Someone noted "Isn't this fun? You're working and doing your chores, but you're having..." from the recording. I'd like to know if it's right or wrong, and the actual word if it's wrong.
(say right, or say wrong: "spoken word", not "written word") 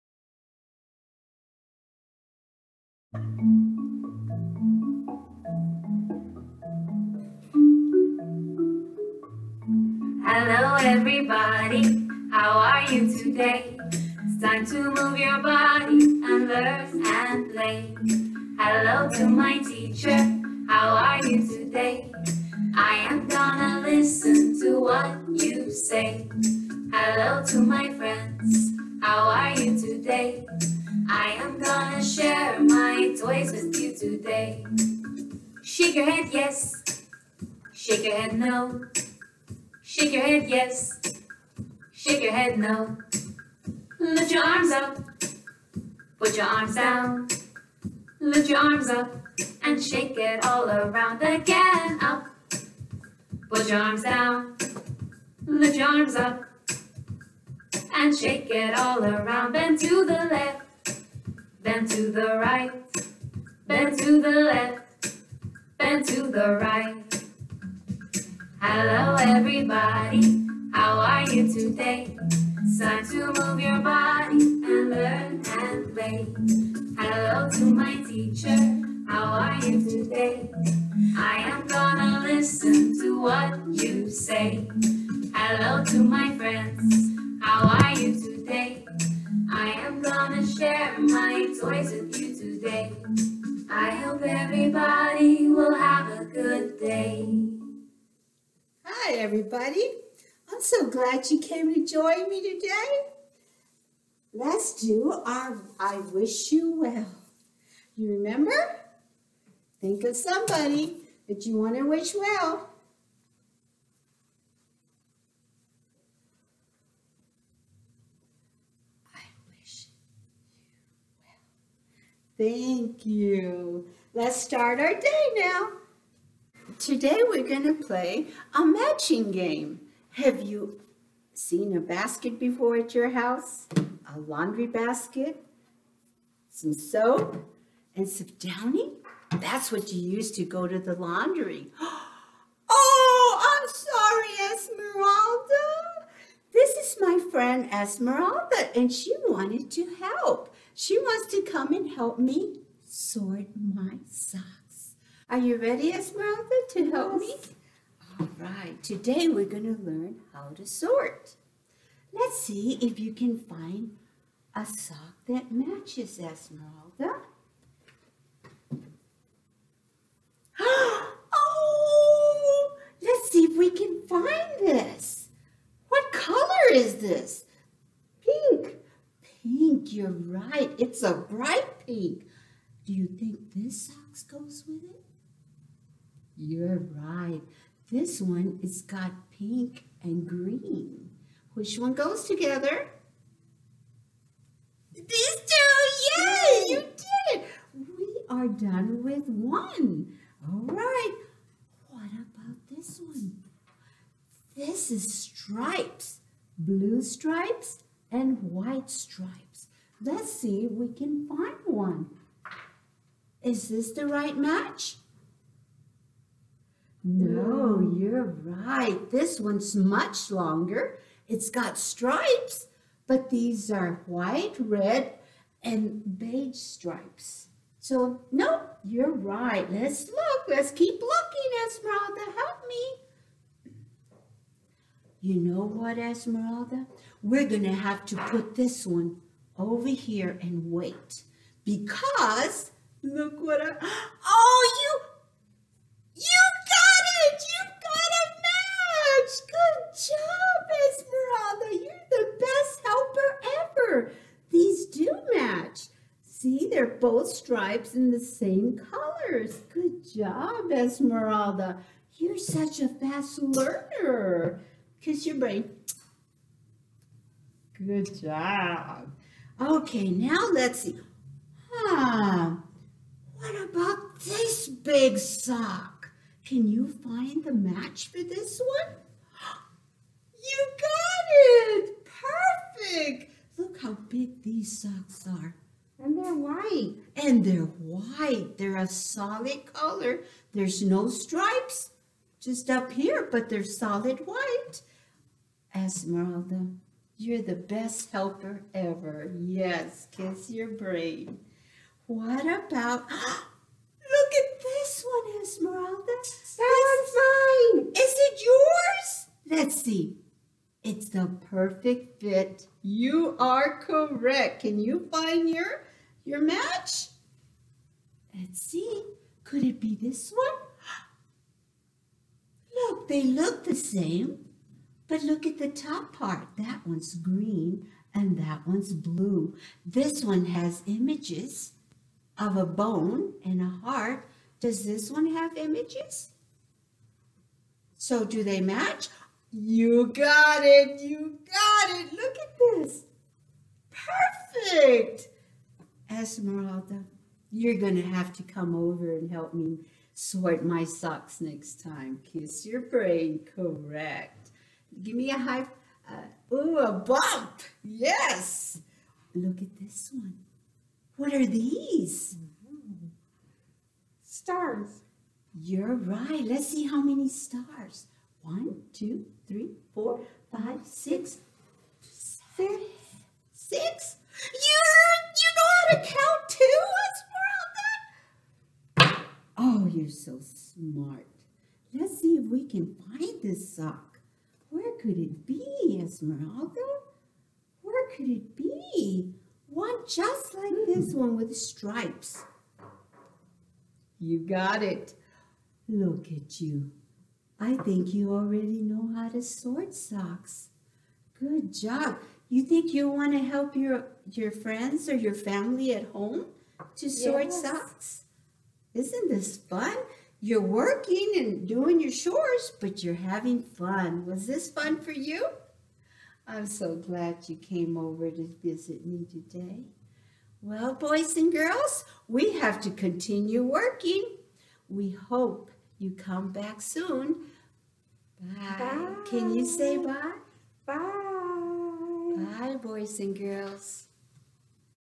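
right.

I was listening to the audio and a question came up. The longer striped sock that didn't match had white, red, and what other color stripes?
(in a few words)
Beige.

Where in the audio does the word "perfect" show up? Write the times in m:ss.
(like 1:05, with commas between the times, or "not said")
4:42, 5:11, 5:43.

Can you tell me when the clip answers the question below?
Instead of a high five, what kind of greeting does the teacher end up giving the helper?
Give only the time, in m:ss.
5:56.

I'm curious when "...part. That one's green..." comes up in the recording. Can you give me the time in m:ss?
5:26.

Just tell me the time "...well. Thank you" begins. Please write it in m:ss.
2:02.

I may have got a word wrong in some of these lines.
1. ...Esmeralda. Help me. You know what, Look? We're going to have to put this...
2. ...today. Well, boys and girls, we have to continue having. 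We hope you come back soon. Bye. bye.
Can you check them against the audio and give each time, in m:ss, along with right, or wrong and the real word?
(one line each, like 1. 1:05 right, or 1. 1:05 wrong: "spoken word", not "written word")
1. 3:51 wrong: "Esmeralda", not "Look"
2. 6:59 wrong: "working", not "having".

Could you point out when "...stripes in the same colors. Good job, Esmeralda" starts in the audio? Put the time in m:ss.
4:17.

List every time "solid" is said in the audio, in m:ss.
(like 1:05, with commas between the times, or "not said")
4:48, 4:53.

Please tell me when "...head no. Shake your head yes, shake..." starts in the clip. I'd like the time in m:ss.
0:38.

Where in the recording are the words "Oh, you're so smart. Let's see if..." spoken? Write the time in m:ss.
6:19.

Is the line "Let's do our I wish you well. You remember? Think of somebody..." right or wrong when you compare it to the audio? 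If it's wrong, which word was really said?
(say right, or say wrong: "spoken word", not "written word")
right.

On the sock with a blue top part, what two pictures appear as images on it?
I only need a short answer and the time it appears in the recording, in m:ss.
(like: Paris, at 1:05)
A bone and a heart, at 5:32.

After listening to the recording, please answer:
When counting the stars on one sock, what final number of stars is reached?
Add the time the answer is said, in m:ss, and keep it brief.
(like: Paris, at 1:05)
6, at 6:10.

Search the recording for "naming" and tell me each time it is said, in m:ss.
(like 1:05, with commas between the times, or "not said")
not said.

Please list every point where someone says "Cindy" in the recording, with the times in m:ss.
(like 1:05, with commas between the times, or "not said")
not said.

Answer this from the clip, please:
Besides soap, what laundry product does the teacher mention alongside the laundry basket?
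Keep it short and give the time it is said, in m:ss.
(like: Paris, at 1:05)
Downy, at 2:18.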